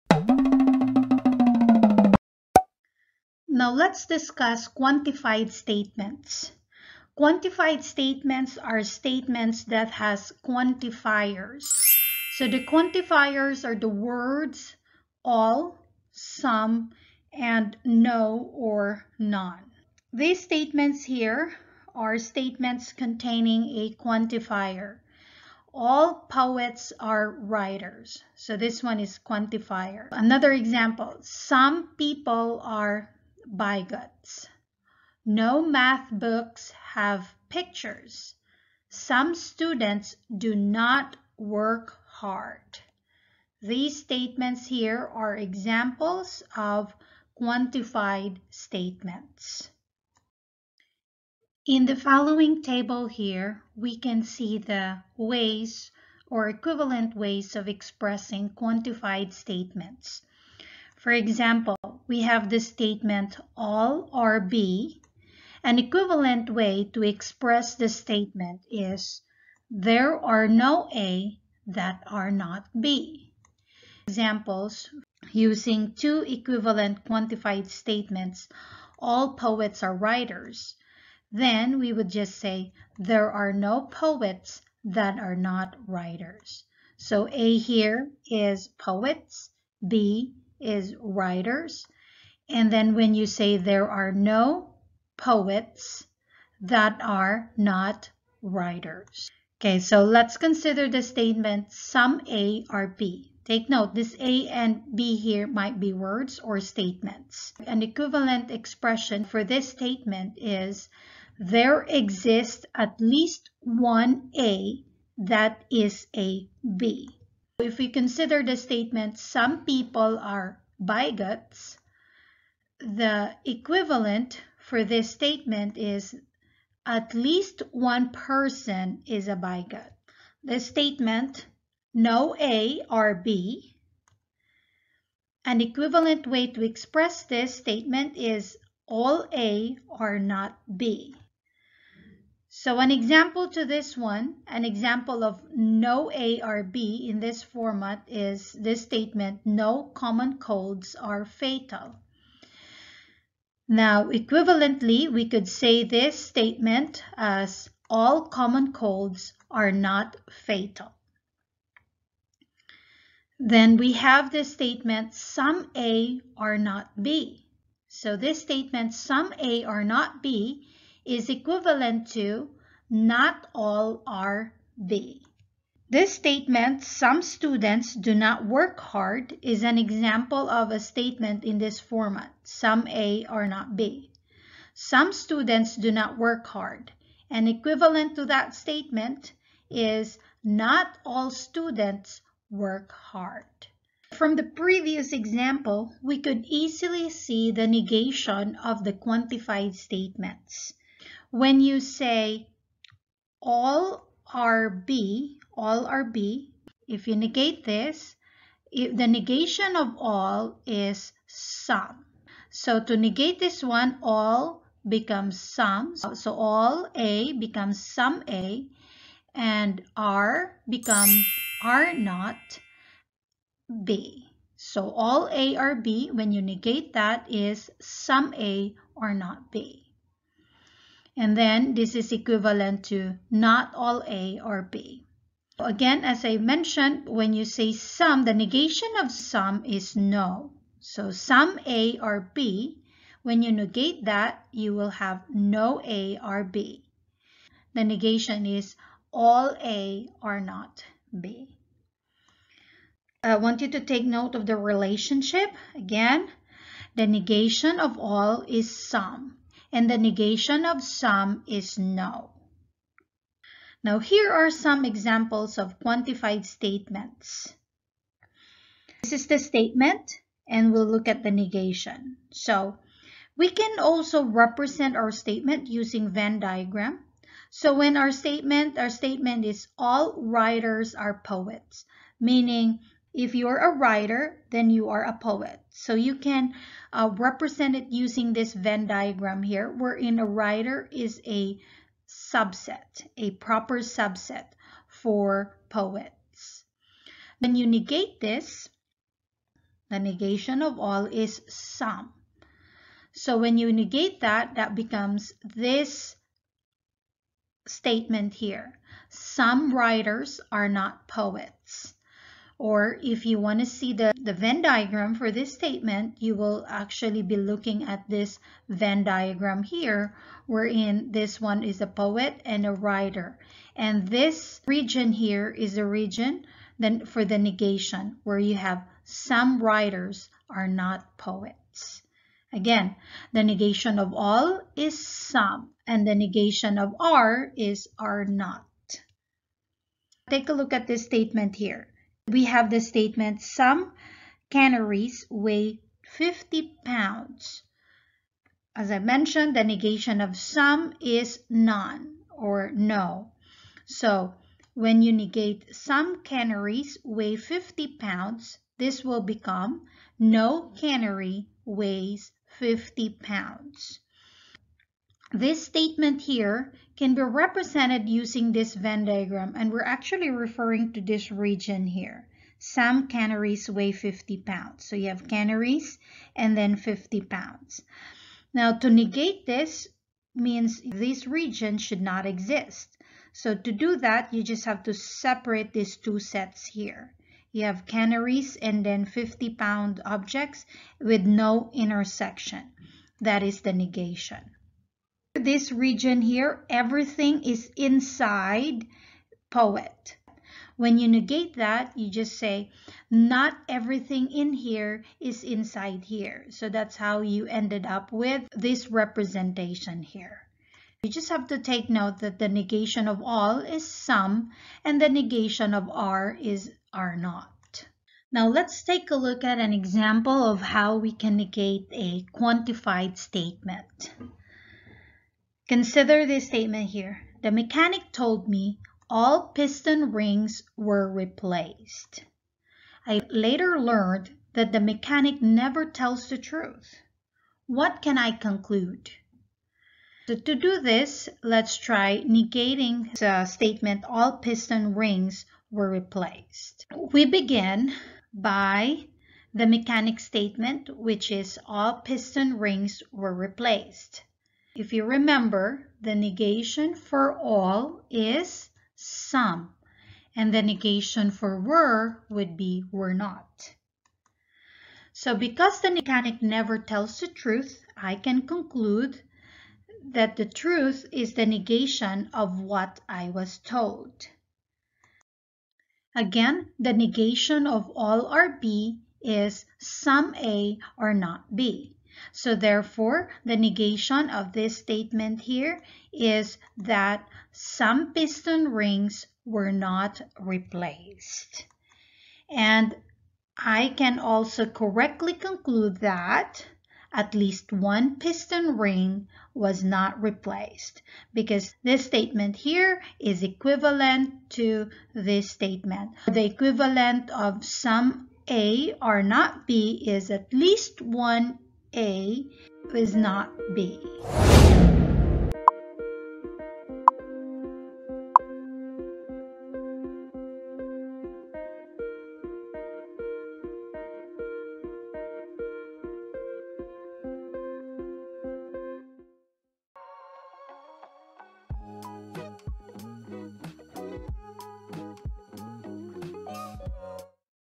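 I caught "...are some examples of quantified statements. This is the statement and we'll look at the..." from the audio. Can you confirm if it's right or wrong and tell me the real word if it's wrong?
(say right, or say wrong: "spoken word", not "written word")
right.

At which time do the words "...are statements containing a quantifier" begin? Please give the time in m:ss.
0:21.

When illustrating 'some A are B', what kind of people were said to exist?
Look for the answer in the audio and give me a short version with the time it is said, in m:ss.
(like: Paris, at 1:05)
bigots, at 2:00.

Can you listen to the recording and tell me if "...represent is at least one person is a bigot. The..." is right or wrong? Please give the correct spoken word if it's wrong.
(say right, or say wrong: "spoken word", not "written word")
wrong: "statement", not "represent".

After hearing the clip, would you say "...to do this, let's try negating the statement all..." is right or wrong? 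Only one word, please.
right.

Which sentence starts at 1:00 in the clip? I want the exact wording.
For example, we have the statement all are B.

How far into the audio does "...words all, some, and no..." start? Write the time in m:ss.
0:13.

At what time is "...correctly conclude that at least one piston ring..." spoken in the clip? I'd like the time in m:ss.
8:14.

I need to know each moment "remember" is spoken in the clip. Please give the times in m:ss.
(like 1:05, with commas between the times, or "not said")
7:35.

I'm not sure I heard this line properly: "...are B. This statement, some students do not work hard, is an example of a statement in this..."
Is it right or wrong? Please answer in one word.
right.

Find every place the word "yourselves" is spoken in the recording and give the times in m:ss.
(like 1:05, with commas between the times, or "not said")
not said.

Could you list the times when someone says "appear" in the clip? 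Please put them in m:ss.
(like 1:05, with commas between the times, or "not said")
not said.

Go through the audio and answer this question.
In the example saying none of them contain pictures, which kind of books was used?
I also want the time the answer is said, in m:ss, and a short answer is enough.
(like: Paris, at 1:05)
math books, at 0:35.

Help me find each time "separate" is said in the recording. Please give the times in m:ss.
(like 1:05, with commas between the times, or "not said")
6:24.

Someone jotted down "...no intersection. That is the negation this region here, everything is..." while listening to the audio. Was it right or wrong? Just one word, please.
right.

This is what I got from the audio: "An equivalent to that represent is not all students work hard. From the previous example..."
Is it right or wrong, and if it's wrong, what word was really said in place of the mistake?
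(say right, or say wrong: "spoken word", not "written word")
wrong: "statement", not "represent".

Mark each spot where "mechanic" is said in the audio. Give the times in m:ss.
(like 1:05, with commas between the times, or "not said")
7:07, 7:14, 7:29, 7:45.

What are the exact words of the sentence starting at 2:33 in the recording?
Now, equivalently, we could say this statement as all common colds are not fatal.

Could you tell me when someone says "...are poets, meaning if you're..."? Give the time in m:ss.
4:40.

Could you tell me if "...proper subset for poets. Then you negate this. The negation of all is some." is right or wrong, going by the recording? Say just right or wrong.
right.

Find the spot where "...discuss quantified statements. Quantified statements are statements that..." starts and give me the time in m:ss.
0:04.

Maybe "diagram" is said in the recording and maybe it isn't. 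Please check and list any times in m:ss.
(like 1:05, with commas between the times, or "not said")
4:36, 4:48, 5:14, 5:19, 6:09.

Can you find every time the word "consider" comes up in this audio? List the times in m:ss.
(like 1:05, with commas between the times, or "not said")
1:40, 1:57, 7:05.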